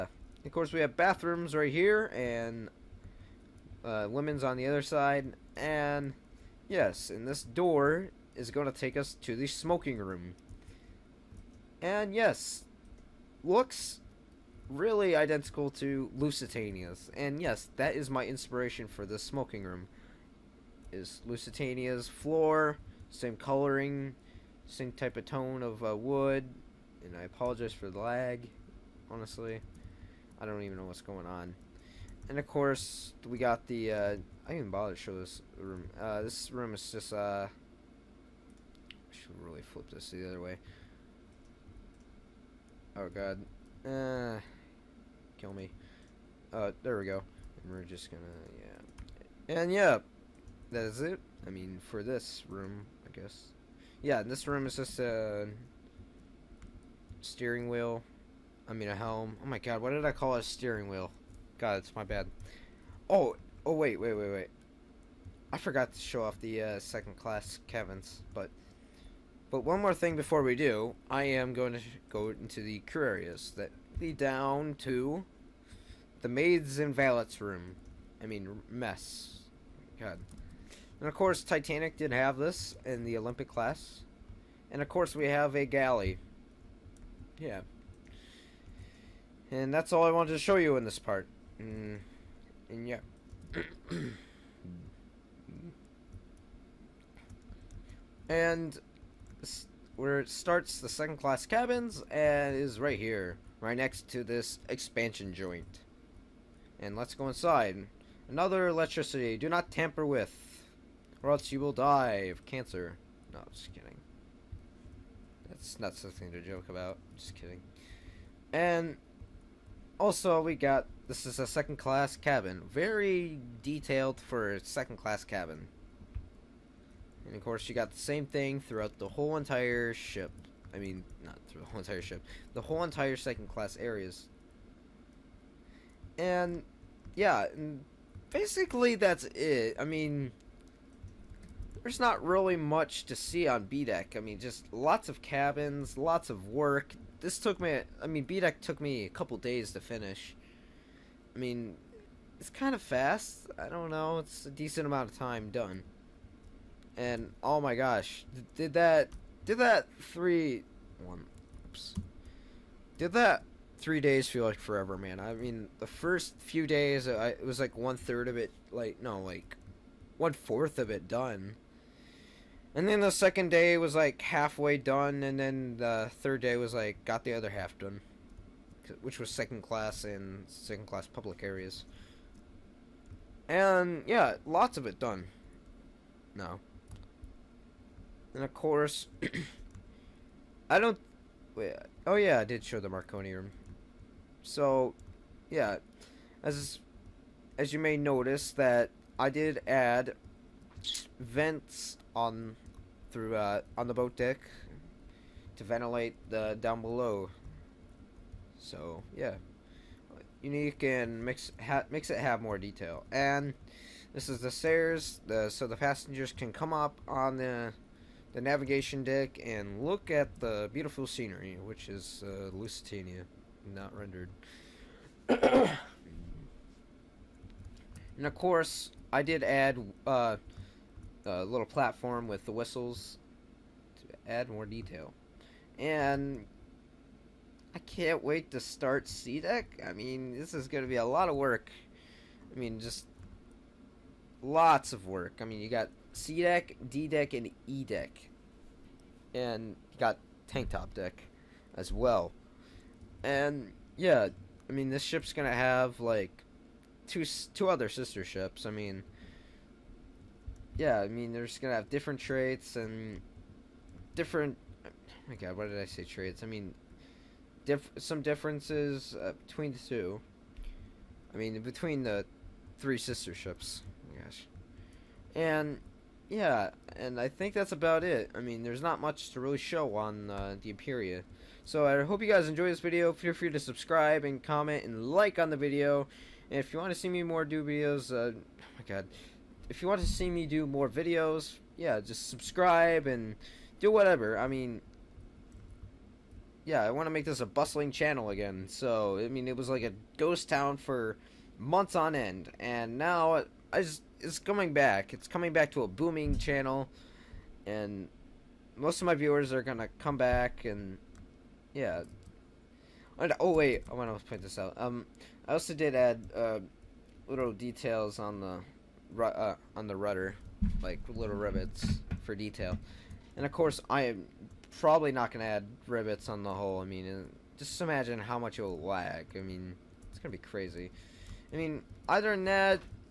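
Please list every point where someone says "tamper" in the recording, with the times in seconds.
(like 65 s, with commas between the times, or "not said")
109 s.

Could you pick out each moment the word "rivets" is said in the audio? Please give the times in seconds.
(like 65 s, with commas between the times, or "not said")
321 s, 325 s.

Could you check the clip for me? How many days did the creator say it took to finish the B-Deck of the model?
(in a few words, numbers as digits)
3.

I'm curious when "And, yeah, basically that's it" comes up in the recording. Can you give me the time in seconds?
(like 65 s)
136 s.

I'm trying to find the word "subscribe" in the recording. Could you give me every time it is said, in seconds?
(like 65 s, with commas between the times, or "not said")
283 s, 292 s.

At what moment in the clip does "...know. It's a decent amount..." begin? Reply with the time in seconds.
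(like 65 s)
153 s.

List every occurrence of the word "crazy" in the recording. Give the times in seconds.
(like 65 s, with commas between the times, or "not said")
330 s.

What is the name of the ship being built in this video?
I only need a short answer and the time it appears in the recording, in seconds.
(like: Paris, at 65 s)
Imperia, at 280 s.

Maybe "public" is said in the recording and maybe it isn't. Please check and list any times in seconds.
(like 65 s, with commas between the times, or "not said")
181 s.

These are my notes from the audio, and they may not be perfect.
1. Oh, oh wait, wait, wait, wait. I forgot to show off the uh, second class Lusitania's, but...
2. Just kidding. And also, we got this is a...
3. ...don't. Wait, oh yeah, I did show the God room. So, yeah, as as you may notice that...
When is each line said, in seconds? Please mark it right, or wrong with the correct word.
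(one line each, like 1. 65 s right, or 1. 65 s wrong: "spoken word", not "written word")
1. 63 s wrong: "Kevin", not "Lusitania"
2. 117 s right
3. 190 s wrong: "Marconi", not "God".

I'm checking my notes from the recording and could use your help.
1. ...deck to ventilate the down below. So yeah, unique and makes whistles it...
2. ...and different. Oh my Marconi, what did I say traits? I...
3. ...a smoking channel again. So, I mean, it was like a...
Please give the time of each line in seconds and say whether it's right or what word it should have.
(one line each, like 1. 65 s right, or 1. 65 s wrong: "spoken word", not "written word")
1. 204 s wrong: "makes", not "whistles"
2. 262 s wrong: "God", not "Marconi"
3. 297 s wrong: "bustling", not "smoking".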